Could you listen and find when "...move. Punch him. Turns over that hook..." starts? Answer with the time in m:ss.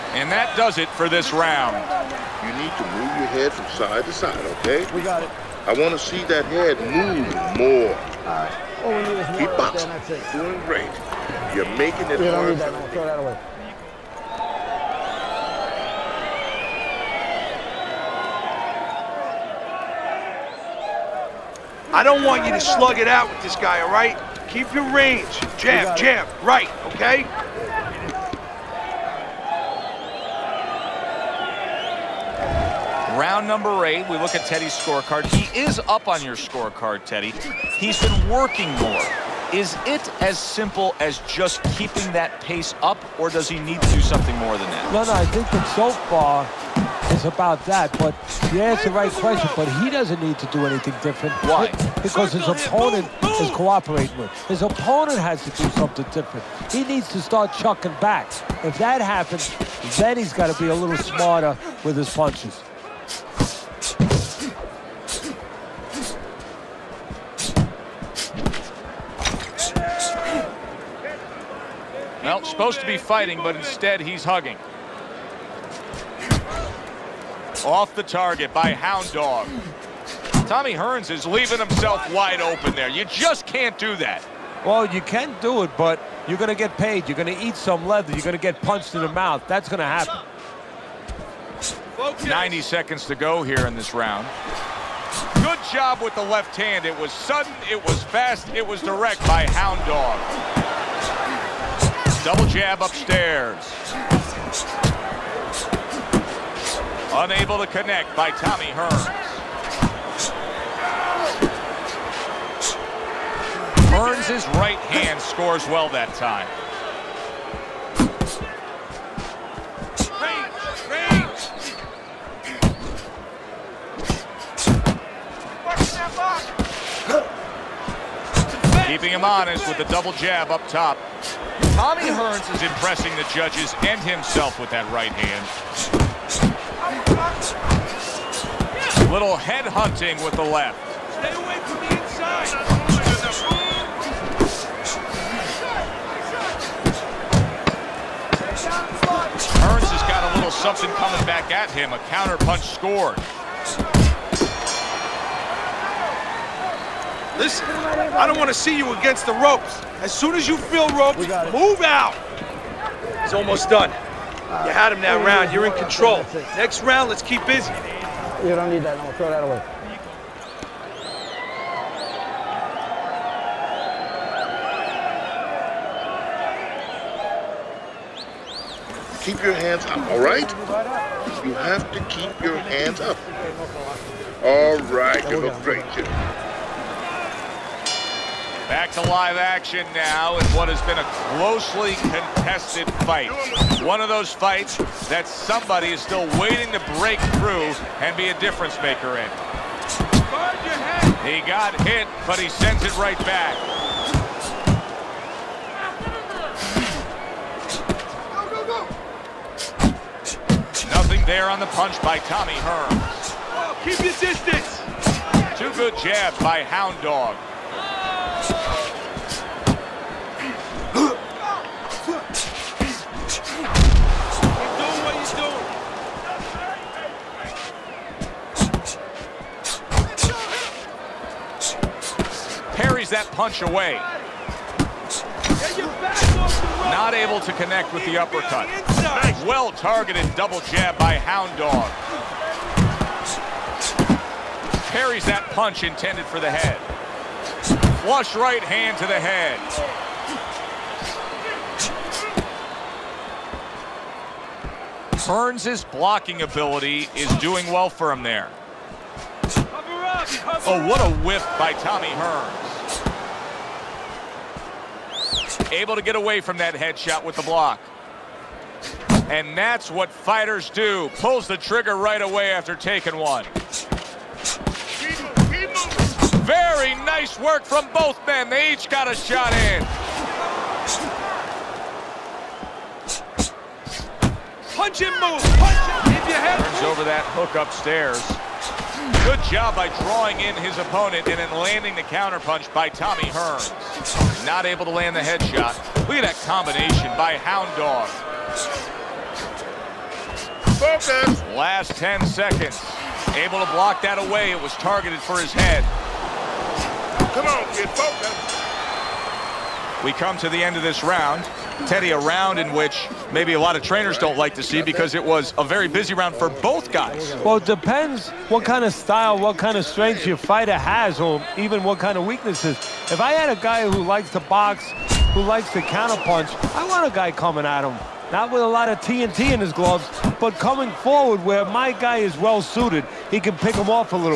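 4:45.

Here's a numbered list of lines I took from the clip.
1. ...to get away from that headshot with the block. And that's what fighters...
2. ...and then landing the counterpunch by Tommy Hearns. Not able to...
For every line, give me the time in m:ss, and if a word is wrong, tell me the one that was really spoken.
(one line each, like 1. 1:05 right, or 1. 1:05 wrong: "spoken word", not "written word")
1. 4:25 right
2. 4:51 right.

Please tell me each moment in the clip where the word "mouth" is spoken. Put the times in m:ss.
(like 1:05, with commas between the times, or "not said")
1:29.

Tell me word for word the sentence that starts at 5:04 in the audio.
It was targeted for his head.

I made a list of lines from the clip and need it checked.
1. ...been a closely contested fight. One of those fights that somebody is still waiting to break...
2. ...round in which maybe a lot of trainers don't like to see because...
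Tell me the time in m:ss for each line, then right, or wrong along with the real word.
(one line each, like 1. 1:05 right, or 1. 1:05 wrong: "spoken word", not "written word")
1. 3:10 right
2. 5:12 right.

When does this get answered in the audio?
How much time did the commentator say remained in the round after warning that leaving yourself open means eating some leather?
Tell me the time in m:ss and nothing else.
1:32.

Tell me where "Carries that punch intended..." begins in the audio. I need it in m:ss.
4:04.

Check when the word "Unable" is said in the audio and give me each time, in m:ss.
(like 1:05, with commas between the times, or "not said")
1:47.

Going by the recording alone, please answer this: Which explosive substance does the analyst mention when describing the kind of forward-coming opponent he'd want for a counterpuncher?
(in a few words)
TNT.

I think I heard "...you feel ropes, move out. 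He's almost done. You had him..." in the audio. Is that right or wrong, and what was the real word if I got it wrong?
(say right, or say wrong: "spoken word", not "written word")
right.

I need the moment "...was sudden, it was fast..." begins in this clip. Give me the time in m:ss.
1:36.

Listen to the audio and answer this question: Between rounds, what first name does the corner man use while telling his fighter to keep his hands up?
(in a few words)
Jimmy.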